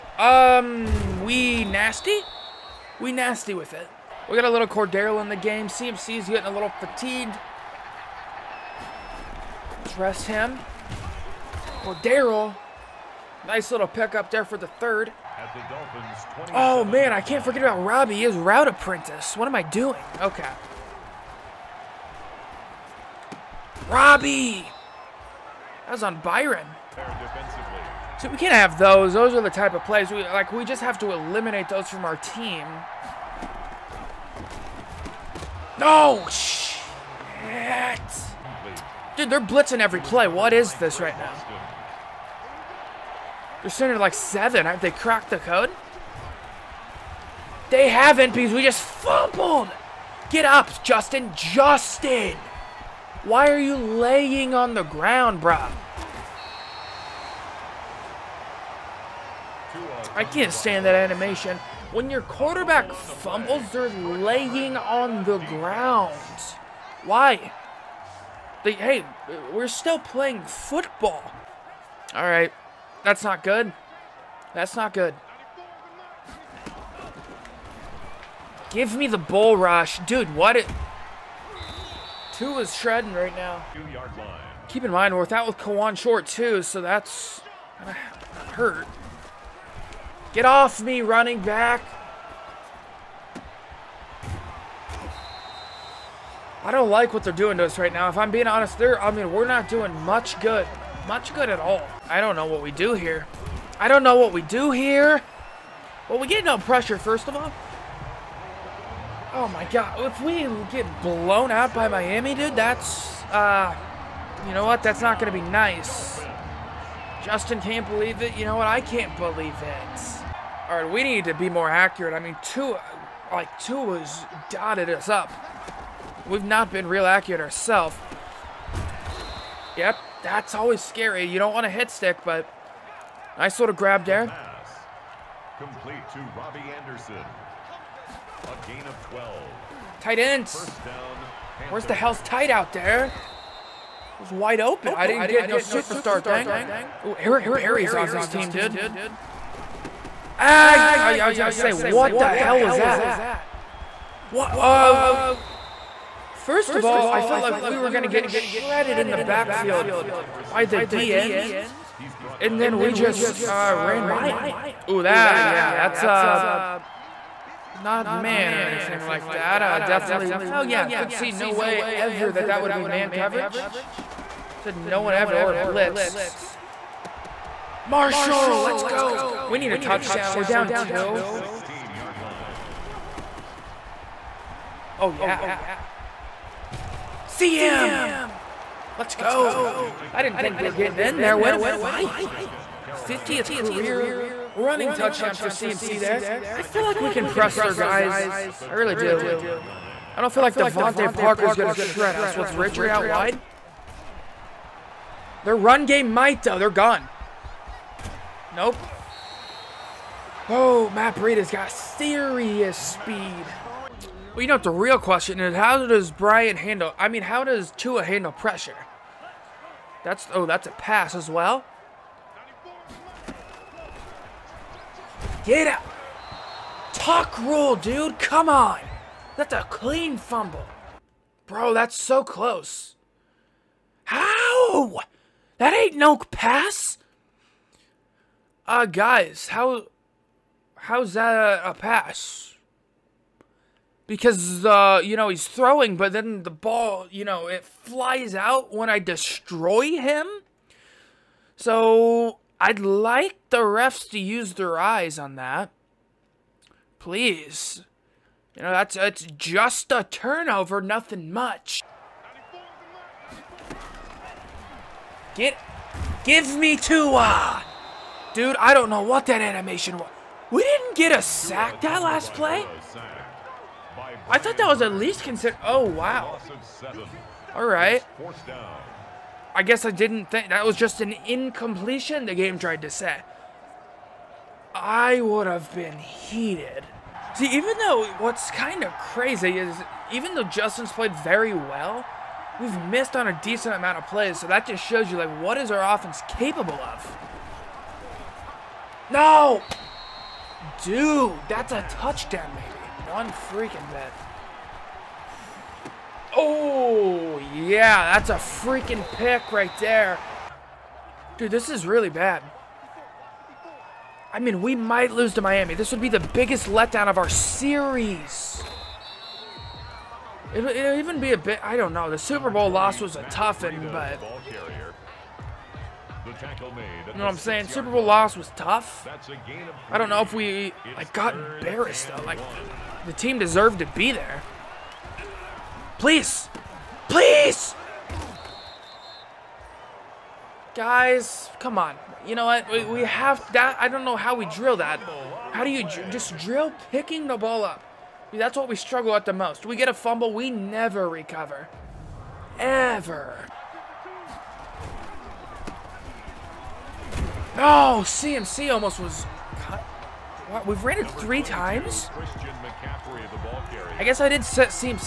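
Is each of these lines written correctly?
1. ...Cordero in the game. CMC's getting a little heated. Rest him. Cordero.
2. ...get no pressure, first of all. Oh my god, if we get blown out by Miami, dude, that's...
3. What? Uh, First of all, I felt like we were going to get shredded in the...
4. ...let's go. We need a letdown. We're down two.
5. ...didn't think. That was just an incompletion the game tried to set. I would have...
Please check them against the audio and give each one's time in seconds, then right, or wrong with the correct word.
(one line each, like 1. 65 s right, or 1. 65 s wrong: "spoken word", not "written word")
1. 4 s wrong: "fatigued", not "heated"
2. 106 s right
3. 154 s right
4. 178 s wrong: "touchdown", not "letdown"
5. 279 s right.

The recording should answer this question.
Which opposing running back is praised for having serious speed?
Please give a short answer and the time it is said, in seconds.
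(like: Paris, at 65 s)
Matt Breida, at 210 s.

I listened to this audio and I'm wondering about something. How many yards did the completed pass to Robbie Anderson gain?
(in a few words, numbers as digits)
12.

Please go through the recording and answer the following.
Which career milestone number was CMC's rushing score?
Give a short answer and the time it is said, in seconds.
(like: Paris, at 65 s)
50th, at 192 s.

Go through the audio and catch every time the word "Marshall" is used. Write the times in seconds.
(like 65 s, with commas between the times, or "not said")
177 s.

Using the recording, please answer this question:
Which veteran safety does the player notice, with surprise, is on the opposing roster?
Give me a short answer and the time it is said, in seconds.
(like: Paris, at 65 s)
Eric Berry, at 147 s.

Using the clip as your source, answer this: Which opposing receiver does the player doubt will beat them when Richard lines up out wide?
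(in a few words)
DeVante Parker.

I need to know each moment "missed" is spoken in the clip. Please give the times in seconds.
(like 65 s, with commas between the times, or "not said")
292 s.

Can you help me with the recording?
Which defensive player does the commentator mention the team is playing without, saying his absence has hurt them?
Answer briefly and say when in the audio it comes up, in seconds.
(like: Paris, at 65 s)
Kawann Short, at 85 s.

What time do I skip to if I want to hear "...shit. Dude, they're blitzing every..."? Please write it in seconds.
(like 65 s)
36 s.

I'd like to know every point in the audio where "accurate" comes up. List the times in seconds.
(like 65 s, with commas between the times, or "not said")
121 s, 127 s.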